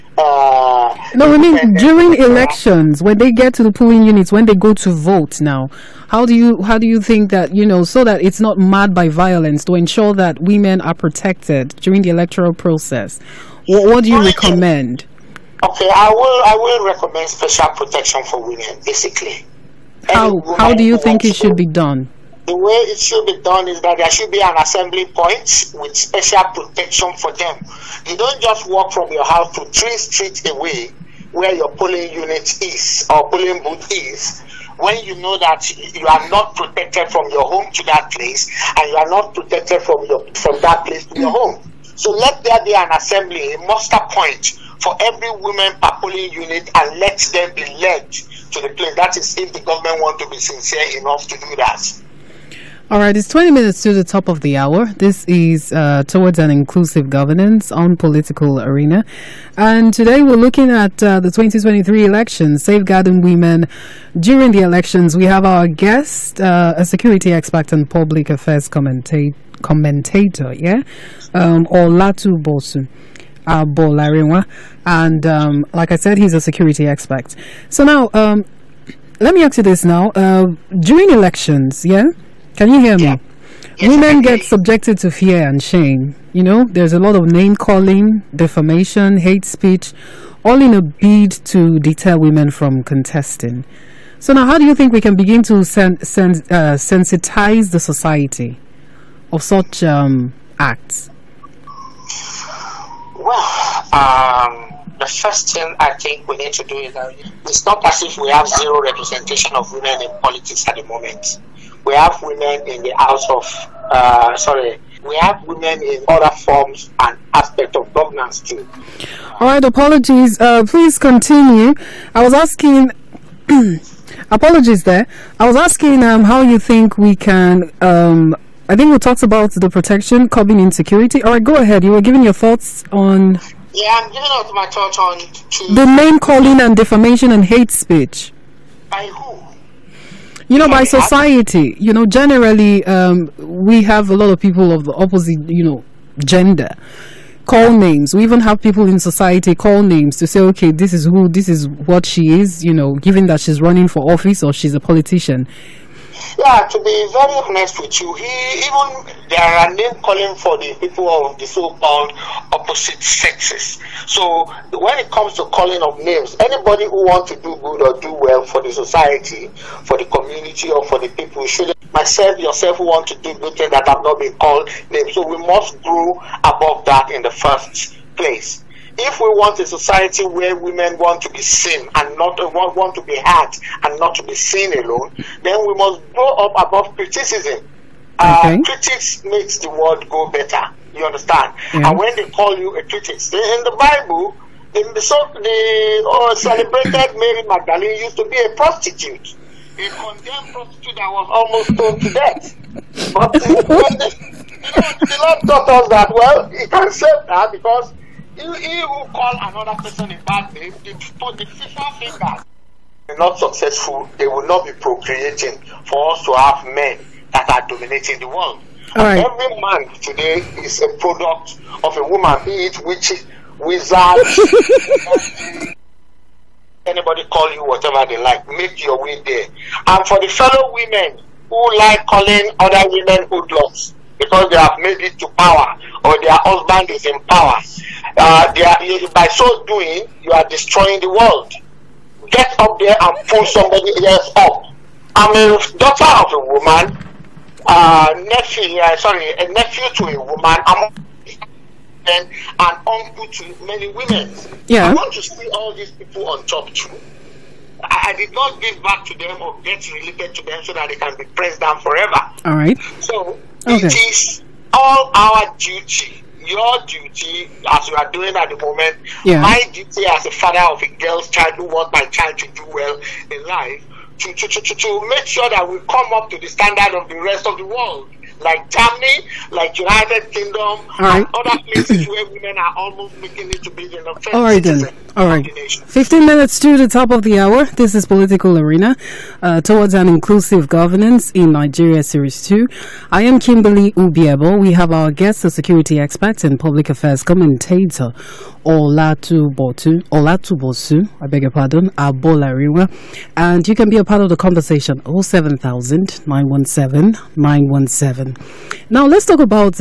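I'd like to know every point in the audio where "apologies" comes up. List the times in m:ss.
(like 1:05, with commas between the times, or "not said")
1:59, 2:04.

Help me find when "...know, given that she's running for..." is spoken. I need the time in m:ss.
2:32.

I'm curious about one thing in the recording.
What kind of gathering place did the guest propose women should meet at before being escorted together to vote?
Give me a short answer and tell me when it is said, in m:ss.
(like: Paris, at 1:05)
muster point, at 0:43.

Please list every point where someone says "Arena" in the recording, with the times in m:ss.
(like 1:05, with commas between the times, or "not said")
0:58, 4:48.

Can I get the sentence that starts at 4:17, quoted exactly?
I, did not give back to them or get related to them so that they can be pressed down forever.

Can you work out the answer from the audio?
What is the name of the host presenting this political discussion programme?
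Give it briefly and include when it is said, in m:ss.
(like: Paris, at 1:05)
Kimberly Ubiebo, at 4:53.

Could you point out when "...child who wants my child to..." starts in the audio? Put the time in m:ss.
4:31.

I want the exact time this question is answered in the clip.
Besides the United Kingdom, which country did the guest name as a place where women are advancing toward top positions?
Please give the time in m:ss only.
4:38.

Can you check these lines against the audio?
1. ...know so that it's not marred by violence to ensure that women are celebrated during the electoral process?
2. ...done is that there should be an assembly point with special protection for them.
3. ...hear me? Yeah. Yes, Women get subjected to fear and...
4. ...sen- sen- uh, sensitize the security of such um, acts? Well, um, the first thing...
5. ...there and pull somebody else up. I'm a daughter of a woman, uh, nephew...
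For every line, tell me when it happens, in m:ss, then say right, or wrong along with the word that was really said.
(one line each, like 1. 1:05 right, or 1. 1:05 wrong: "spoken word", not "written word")
1. 0:07 wrong: "protected", not "celebrated"
2. 0:23 right
3. 1:22 right
4. 1:35 wrong: "society", not "security"
5. 4:02 right.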